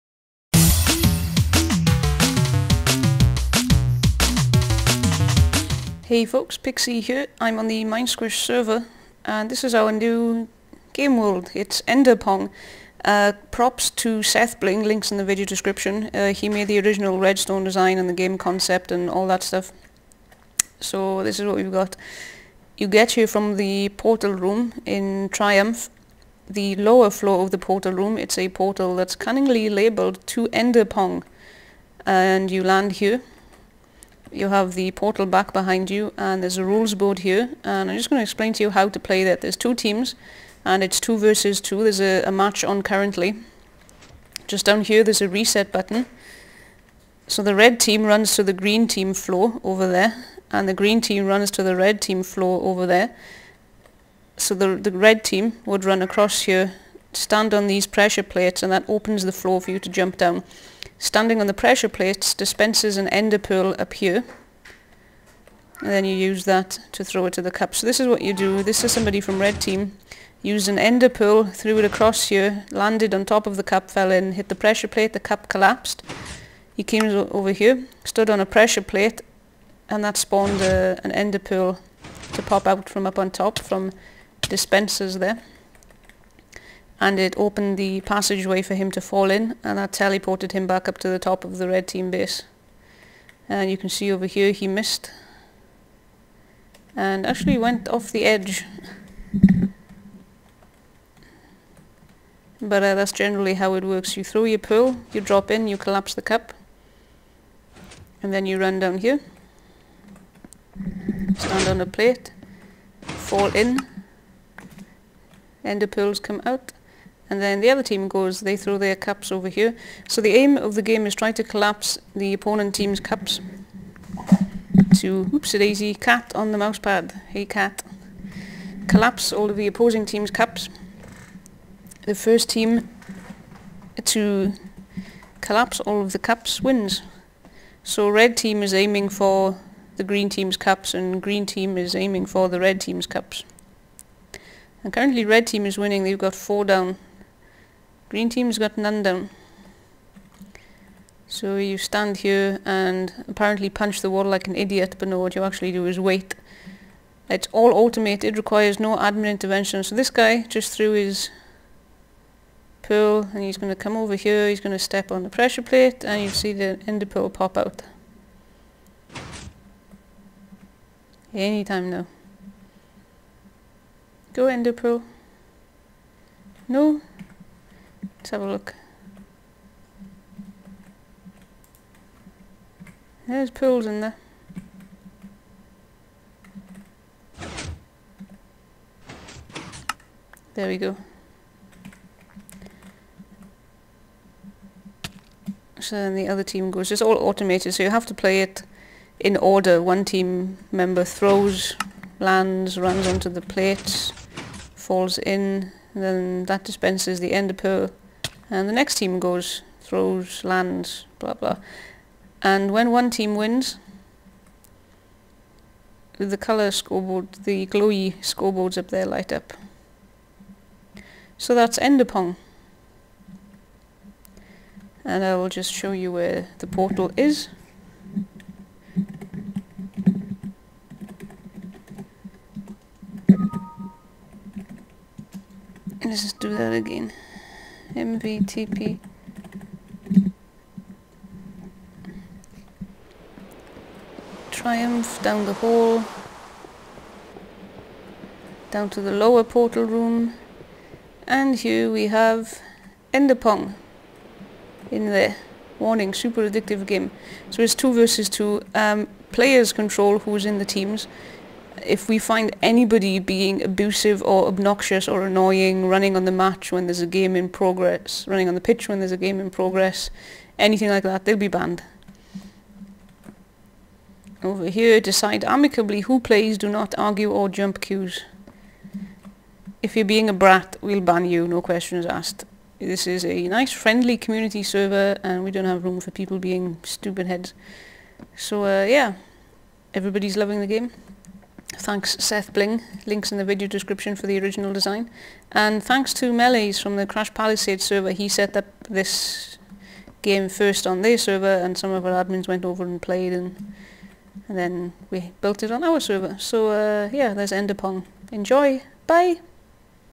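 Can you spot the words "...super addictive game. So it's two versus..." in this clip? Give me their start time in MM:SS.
04:16.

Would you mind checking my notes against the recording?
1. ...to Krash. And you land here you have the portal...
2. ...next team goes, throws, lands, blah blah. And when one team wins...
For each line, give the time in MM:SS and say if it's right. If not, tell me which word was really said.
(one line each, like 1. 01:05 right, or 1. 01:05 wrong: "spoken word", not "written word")
1. 00:30 wrong: "Enderpong", not "Krash"
2. 03:28 right.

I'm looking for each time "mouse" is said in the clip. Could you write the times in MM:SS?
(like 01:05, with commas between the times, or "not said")
02:06.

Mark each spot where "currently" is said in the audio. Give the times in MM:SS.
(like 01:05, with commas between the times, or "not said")
00:42, 02:24.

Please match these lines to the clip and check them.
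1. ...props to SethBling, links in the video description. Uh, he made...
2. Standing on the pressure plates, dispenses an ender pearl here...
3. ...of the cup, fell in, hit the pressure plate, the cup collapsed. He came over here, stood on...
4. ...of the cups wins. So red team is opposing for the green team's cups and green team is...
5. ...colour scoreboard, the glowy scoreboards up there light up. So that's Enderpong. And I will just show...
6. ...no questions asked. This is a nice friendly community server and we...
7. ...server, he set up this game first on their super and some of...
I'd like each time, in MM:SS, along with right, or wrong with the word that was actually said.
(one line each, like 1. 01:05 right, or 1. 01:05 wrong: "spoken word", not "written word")
1. 00:13 right
2. 01:01 right
3. 01:13 right
4. 02:16 wrong: "aiming", not "opposing"
5. 03:36 right
6. 04:41 right
7. 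04:57 wrong: "server", not "super".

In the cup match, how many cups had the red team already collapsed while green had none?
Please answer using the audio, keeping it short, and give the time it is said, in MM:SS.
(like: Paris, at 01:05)
4, at 02:26.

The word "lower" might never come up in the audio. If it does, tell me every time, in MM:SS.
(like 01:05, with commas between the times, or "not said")
00:26, 04:09.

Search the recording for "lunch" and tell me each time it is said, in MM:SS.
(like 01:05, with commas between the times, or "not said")
not said.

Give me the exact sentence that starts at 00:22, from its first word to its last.
You get here from the portal room in Triumph.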